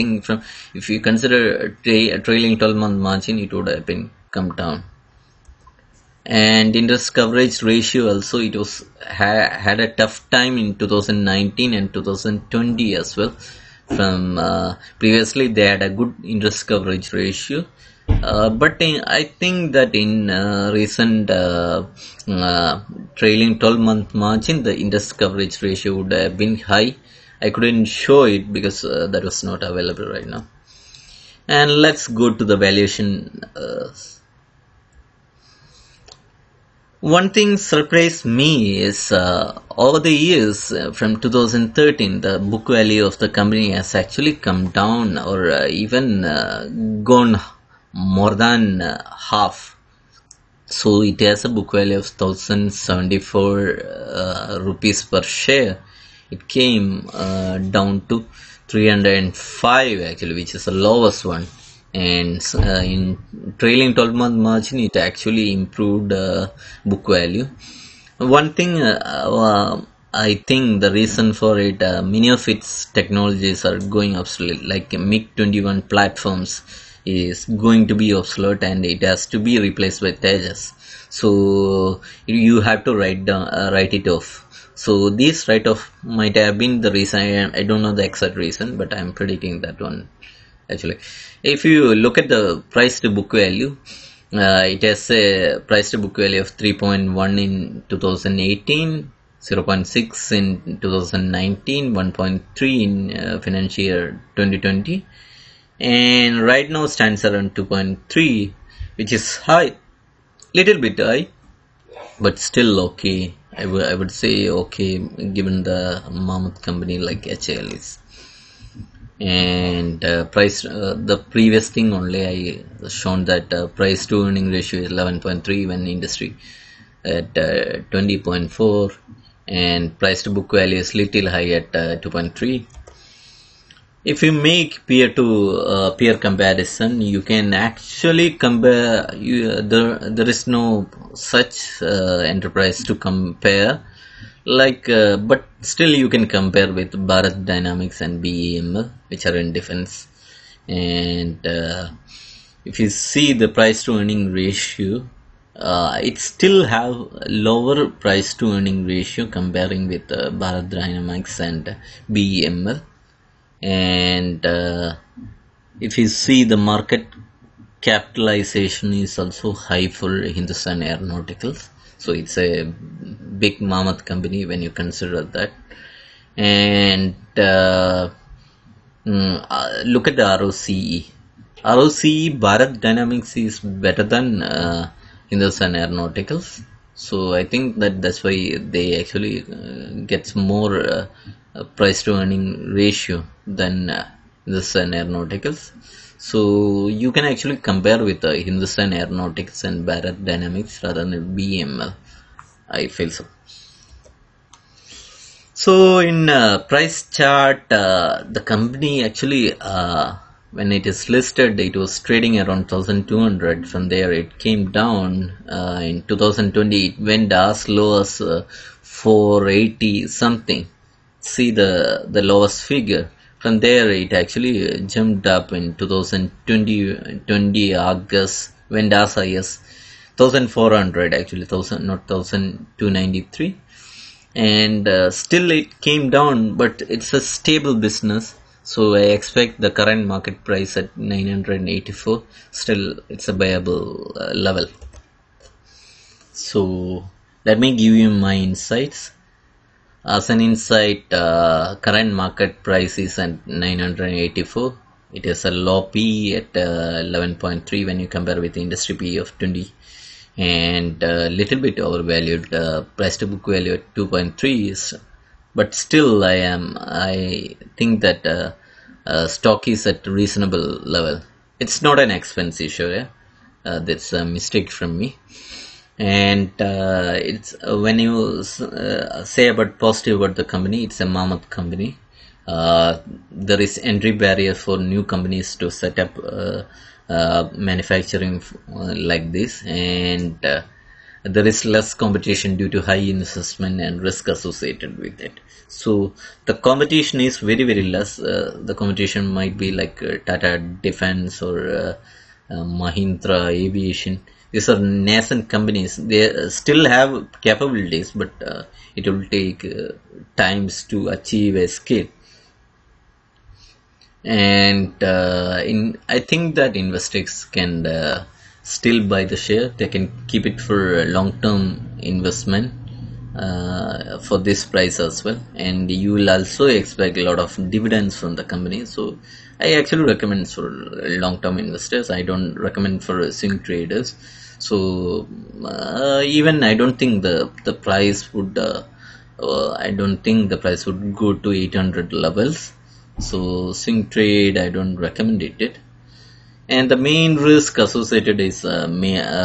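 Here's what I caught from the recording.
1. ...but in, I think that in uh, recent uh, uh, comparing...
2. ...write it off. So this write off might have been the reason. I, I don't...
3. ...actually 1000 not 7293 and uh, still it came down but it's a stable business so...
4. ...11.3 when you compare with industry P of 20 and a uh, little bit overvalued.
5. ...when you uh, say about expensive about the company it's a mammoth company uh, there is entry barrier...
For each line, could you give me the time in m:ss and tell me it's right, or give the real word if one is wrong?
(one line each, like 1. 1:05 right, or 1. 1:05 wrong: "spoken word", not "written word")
1. 0:18 wrong: "trailing", not "comparing"
2. 1:23 right
3. 3:51 wrong: "1293", not "7293"
4. 4:17 right
5. 4:37 wrong: "positive", not "expensive".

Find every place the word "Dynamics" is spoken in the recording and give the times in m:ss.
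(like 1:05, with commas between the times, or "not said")
2:27, 2:40, 3:02, 3:20.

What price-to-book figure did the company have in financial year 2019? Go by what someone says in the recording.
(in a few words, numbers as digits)
0.6.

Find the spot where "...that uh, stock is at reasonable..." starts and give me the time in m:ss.
4:27.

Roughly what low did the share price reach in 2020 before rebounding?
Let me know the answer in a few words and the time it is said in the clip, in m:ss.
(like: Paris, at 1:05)
480, at 3:38.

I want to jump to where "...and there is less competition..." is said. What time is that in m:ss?
4:49.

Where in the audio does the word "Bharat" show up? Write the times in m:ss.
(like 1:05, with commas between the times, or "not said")
2:27, 2:40, 3:02, 3:19.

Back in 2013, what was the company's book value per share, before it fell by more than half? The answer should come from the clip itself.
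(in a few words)
1074 rupees.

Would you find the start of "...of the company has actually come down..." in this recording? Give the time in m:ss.
0:43.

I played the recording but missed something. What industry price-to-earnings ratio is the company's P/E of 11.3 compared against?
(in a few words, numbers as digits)
20.4.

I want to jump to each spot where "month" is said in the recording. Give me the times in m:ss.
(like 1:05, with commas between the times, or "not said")
0:02, 0:23, 1:04.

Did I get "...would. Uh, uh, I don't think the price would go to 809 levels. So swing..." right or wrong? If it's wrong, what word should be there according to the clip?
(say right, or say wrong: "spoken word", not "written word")
wrong: "800", not "809".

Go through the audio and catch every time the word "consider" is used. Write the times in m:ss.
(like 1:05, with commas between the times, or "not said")
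0:01, 2:54.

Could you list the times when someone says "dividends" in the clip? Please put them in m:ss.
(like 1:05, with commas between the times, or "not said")
5:27.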